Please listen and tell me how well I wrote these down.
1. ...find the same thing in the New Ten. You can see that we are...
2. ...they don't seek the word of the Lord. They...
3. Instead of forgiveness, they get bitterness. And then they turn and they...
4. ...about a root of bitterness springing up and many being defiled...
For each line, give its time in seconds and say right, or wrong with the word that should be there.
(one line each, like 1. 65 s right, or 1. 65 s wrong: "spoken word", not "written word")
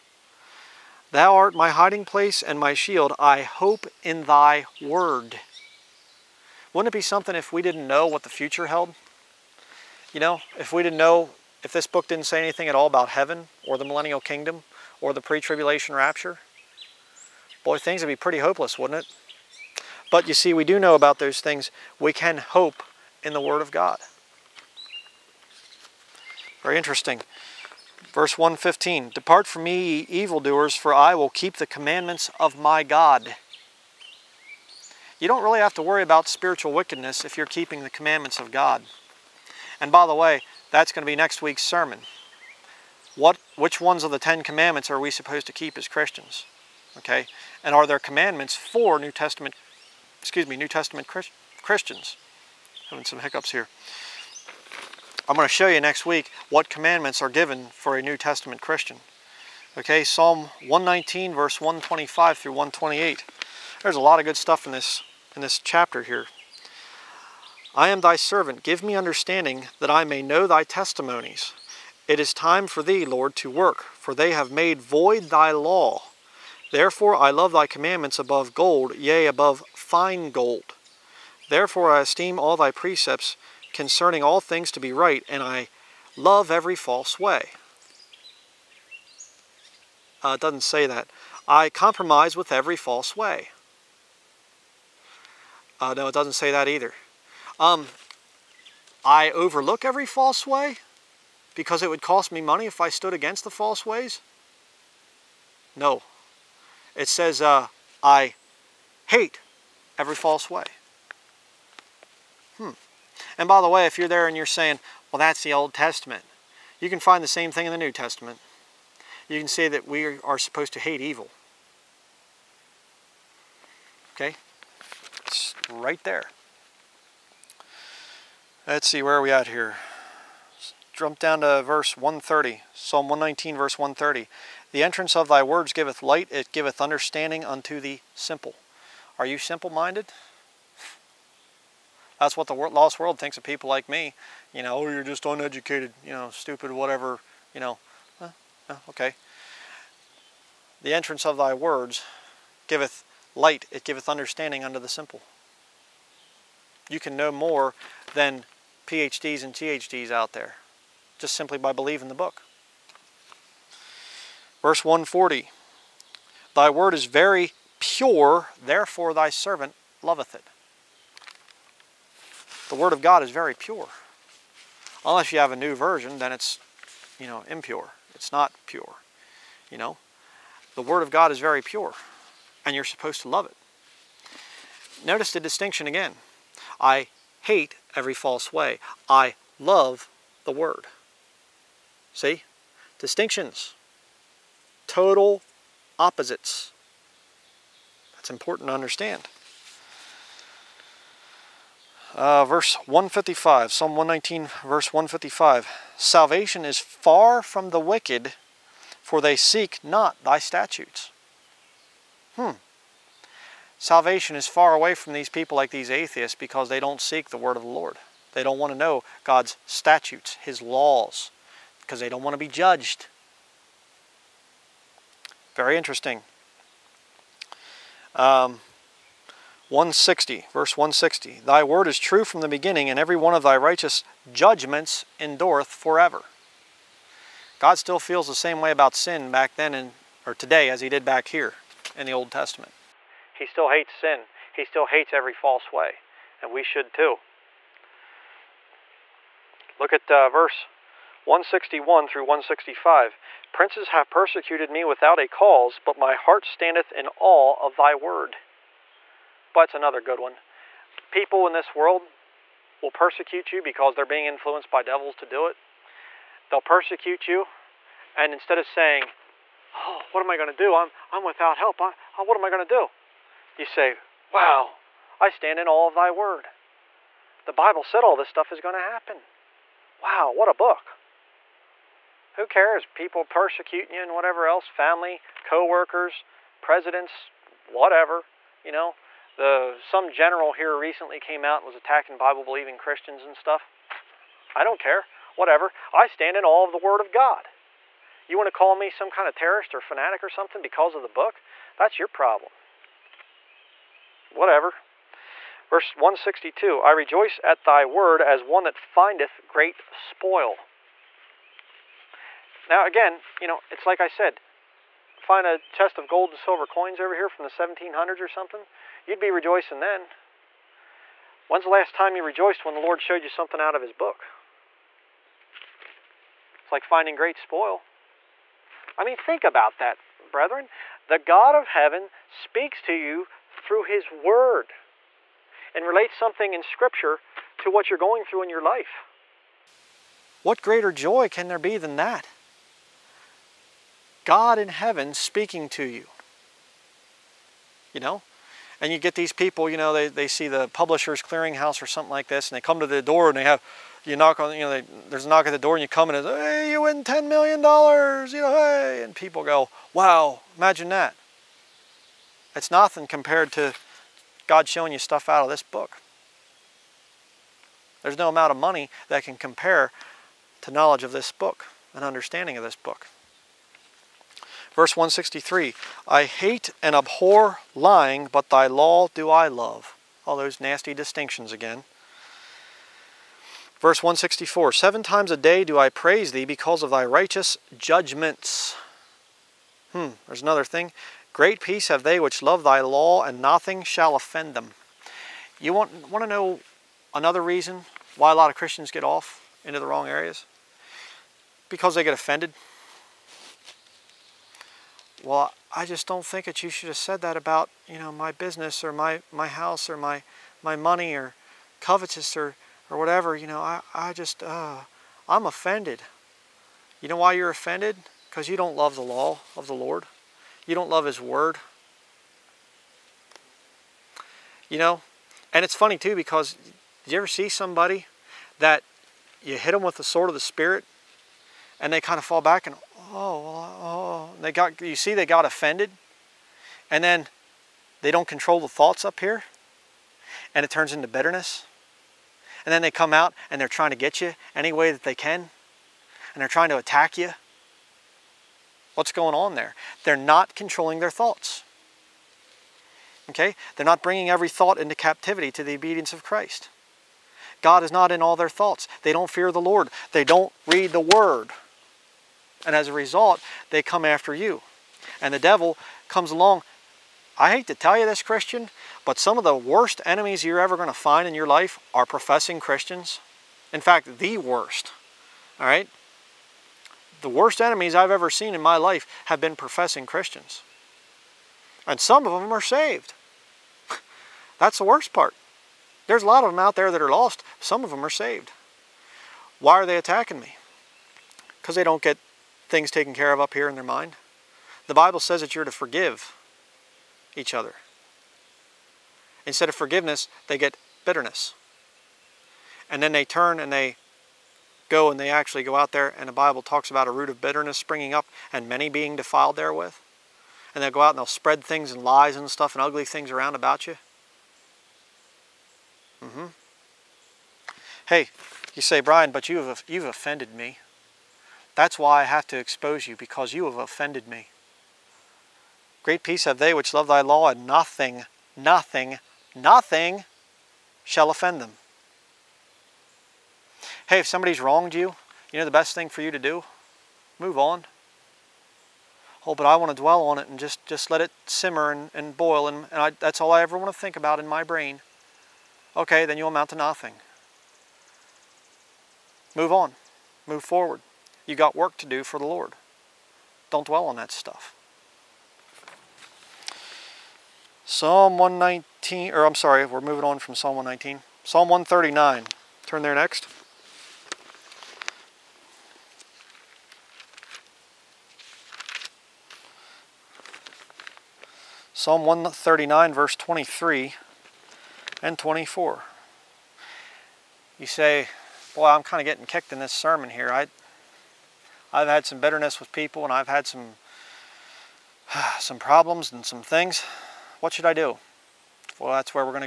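1. 117 s wrong: "Testament", not "Ten"
2. 216 s right
3. 499 s right
4. 506 s right.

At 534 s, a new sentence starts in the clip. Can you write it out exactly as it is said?
Hey, if somebody's wronged you, you know the best thing for you to do?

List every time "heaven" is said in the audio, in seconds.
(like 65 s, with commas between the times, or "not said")
13 s, 331 s, 344 s.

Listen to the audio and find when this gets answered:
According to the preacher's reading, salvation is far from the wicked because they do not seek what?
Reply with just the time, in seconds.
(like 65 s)
210 s.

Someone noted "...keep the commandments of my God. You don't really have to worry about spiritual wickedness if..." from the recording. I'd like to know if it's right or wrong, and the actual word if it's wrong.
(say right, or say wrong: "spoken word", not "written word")
right.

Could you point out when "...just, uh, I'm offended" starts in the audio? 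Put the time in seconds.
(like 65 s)
414 s.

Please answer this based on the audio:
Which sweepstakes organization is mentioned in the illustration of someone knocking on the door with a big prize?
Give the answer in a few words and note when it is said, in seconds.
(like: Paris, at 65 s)
Publisher's Clearinghouse, at 350 s.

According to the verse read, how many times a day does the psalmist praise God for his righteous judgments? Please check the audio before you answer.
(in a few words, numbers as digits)
7.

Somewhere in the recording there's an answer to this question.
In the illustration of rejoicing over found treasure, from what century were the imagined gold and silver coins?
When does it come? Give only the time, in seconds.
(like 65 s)
317 s.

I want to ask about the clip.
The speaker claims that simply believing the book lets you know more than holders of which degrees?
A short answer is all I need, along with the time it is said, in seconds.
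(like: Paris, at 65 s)
PhDs and THDs, at 158 s.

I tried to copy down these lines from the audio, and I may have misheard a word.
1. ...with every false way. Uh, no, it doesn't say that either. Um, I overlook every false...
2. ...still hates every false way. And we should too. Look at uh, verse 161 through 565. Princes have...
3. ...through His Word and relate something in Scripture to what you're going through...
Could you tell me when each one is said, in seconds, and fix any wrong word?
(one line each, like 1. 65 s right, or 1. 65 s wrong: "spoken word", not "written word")
1. 92 s right
2. 244 s wrong: "165", not "565"
3. 333 s right.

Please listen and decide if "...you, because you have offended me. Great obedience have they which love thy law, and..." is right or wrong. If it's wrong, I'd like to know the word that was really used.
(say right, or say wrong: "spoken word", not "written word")
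wrong: "peace", not "obedience".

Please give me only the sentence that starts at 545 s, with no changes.
Okay, then you'll amount to nothing.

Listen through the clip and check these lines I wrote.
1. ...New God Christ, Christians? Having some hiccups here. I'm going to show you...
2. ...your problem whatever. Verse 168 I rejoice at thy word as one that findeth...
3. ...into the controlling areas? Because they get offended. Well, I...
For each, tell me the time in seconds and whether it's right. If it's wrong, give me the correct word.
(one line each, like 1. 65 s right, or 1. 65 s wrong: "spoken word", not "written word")
1. 50 s wrong: "Testament", not "God"
2. 301 s wrong: "162", not "168"
3. 399 s wrong: "wrong", not "controlling".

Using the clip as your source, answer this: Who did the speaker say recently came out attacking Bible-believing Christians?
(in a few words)
Some general.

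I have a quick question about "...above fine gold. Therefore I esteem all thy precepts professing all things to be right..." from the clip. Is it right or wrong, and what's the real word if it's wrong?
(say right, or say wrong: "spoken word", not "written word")
wrong: "concerning", not "professing".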